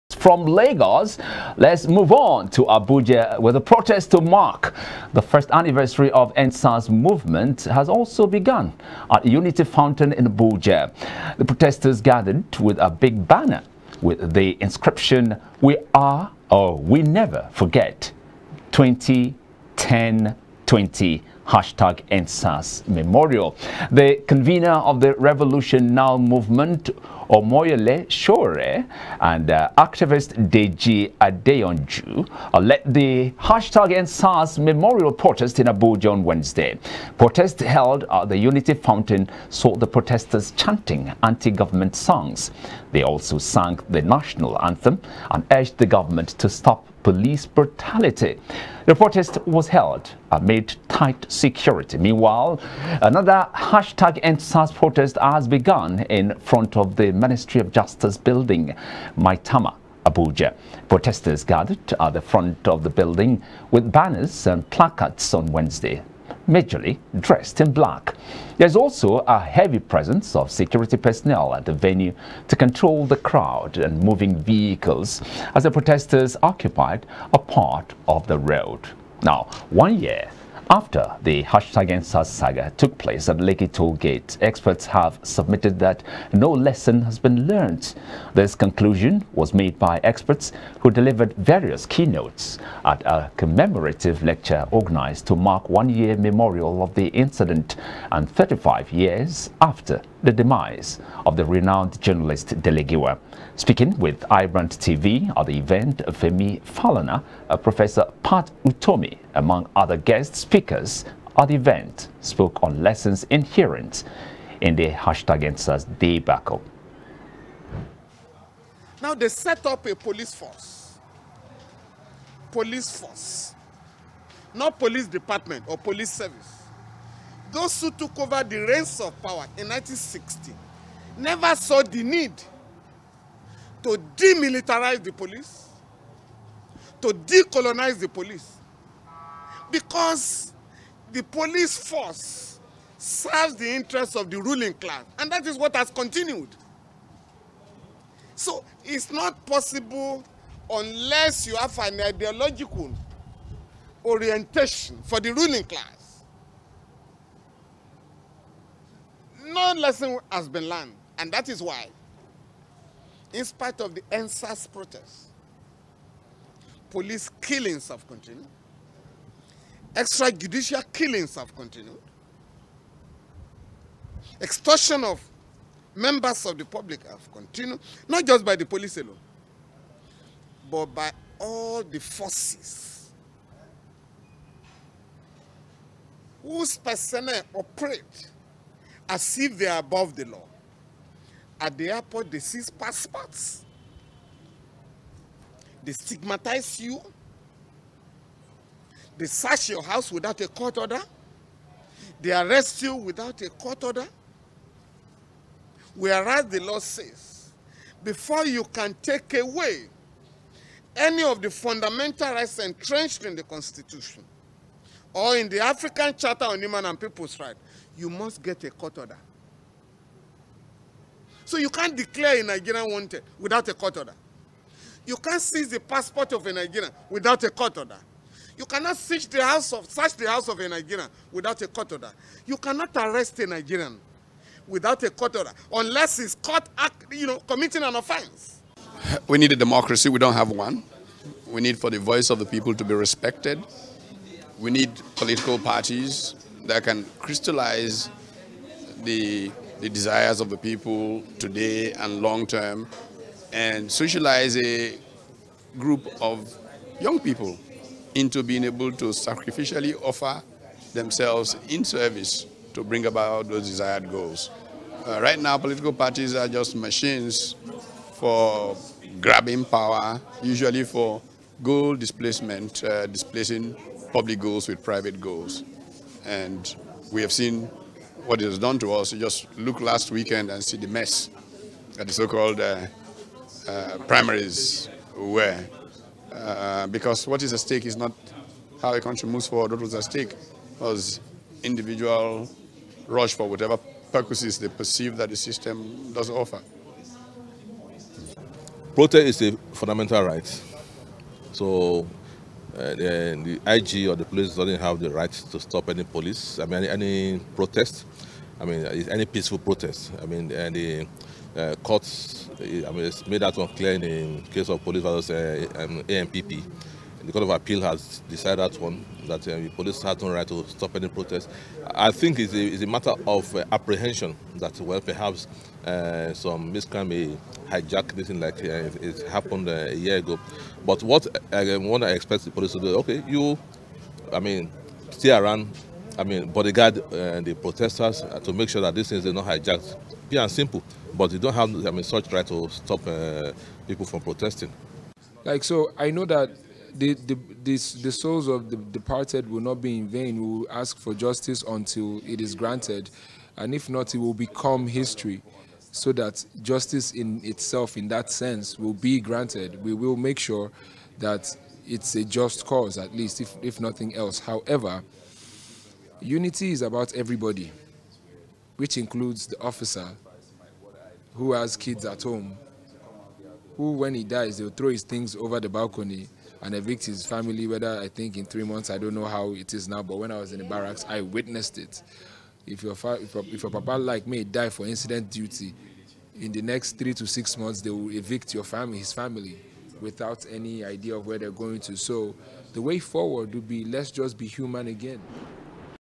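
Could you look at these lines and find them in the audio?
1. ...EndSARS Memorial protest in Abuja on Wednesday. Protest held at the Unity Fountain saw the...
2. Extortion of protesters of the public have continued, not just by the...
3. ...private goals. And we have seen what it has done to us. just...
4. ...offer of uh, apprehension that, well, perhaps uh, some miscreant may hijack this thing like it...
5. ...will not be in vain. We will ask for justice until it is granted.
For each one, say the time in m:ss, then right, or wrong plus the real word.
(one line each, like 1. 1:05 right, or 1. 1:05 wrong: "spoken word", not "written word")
1. 0:33 right
2. 2:54 wrong: "members", not "protesters"
3. 4:34 right
4. 5:22 wrong: "matter", not "offer"
5. 5:49 right.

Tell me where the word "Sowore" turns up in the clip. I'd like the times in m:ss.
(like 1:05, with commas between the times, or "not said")
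0:28.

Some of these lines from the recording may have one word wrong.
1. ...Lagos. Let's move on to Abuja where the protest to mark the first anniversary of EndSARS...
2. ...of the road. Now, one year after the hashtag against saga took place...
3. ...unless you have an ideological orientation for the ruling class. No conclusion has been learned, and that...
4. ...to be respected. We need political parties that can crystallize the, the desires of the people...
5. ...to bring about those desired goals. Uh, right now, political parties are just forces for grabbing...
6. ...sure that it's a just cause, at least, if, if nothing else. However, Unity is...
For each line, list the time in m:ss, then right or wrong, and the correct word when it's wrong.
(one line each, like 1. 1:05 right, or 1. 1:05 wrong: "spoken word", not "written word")
1. 0:00 right
2. 1:18 right
3. 2:30 wrong: "lesson", not "conclusion"
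4. 4:02 right
5. 4:22 wrong: "machines", not "forces"
6. 6:00 right.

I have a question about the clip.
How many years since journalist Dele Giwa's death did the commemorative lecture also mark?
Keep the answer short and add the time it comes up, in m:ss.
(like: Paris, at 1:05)
35 years, at 1:38.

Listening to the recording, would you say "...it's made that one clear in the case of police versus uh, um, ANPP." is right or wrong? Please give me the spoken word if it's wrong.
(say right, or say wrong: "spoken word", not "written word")
right.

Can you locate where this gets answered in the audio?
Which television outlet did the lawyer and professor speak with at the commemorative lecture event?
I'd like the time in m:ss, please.
1:44.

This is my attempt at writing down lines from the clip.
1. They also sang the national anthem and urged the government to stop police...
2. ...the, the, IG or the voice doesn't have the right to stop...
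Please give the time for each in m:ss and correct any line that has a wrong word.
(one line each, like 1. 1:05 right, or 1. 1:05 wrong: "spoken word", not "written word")
1. 0:42 right
2. 5:02 wrong: "police", not "voice".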